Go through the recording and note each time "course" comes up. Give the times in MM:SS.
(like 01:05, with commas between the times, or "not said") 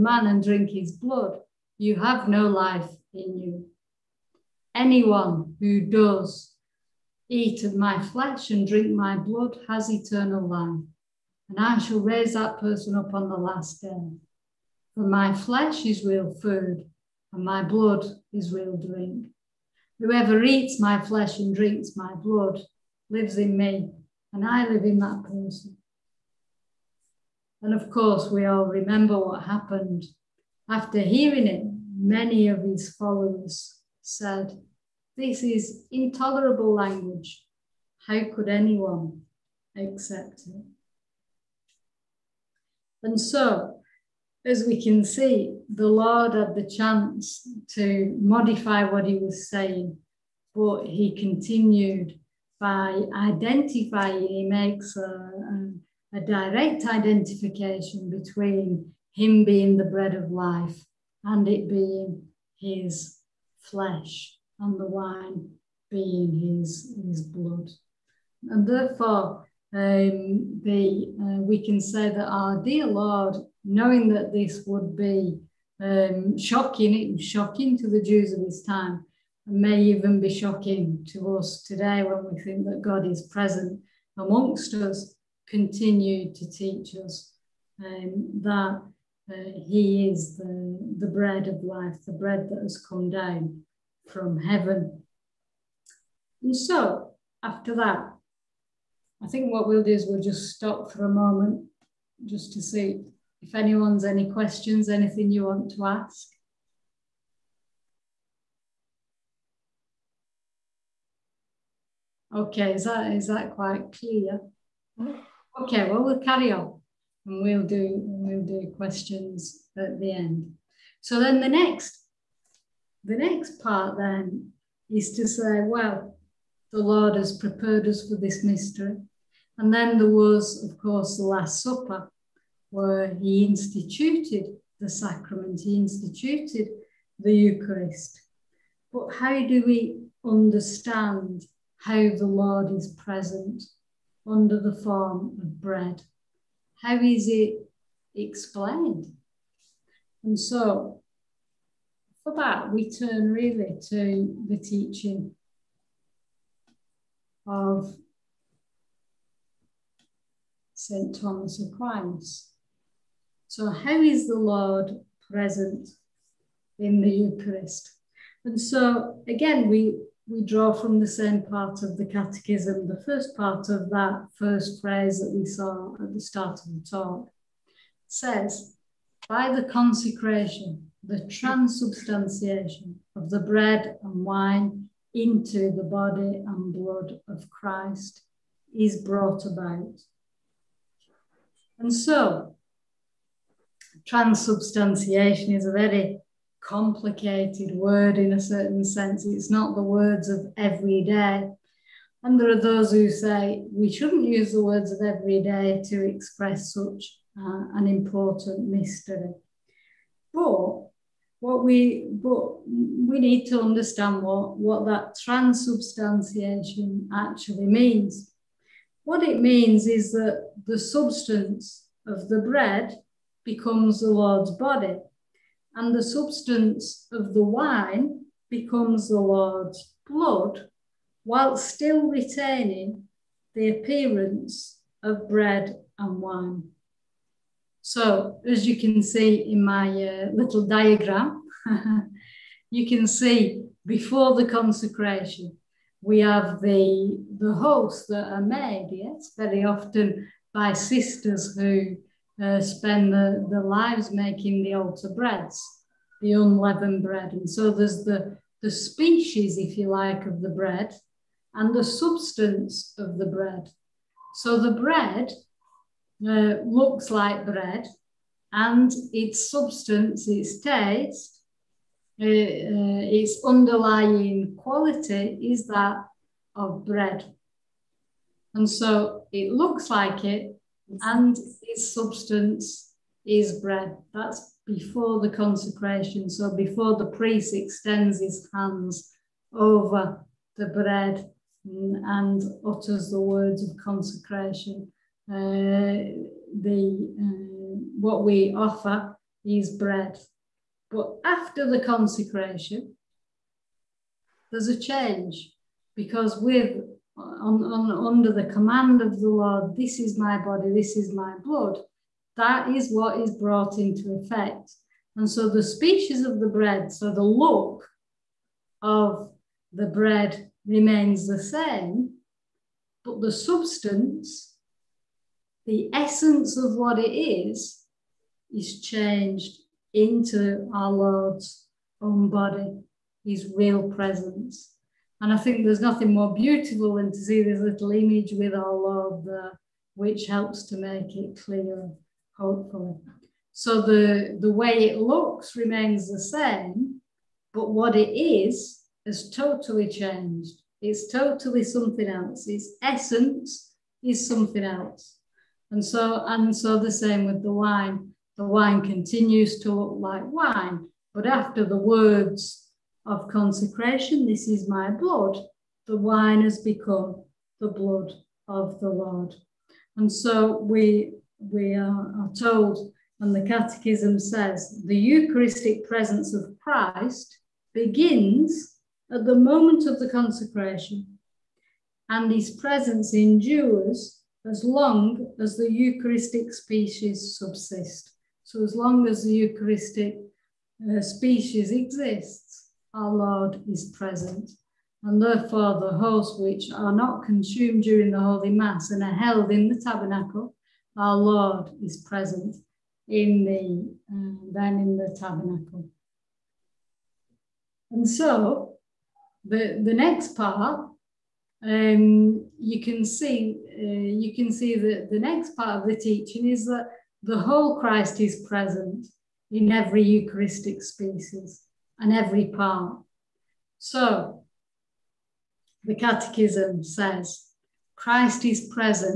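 00:27, 02:10.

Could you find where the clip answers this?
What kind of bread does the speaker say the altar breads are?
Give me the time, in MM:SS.
04:16.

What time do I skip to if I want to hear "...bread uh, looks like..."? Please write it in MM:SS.
04:24.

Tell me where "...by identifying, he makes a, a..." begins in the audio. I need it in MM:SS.
00:52.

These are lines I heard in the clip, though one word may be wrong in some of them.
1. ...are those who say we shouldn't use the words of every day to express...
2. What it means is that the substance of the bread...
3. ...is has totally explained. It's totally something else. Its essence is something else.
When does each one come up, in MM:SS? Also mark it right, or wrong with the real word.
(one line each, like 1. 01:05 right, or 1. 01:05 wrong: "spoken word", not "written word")
1. 03:22 right
2. 03:39 right
3. 05:48 wrong: "changed", not "explained".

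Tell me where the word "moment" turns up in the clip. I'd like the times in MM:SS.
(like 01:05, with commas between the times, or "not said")
01:41, 06:19.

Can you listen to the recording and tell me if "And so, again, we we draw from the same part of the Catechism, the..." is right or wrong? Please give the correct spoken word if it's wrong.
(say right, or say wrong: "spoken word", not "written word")
right.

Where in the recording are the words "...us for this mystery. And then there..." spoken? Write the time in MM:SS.
02:07.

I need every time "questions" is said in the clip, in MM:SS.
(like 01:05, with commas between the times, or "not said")
01:44, 01:58.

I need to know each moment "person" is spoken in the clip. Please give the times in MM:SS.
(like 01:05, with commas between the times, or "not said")
00:12, 00:25.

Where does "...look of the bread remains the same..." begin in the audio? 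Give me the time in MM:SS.
05:17.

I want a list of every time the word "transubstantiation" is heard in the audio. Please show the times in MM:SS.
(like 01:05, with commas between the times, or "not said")
03:01, 03:14, 03:35.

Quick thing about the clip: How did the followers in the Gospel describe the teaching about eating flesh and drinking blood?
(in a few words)
Intolerable.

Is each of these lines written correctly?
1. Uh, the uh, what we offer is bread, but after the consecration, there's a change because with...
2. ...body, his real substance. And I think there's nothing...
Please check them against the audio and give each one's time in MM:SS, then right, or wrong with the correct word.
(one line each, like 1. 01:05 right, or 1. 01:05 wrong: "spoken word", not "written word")
1. 04:55 right
2. 05:32 wrong: "presence", not "substance".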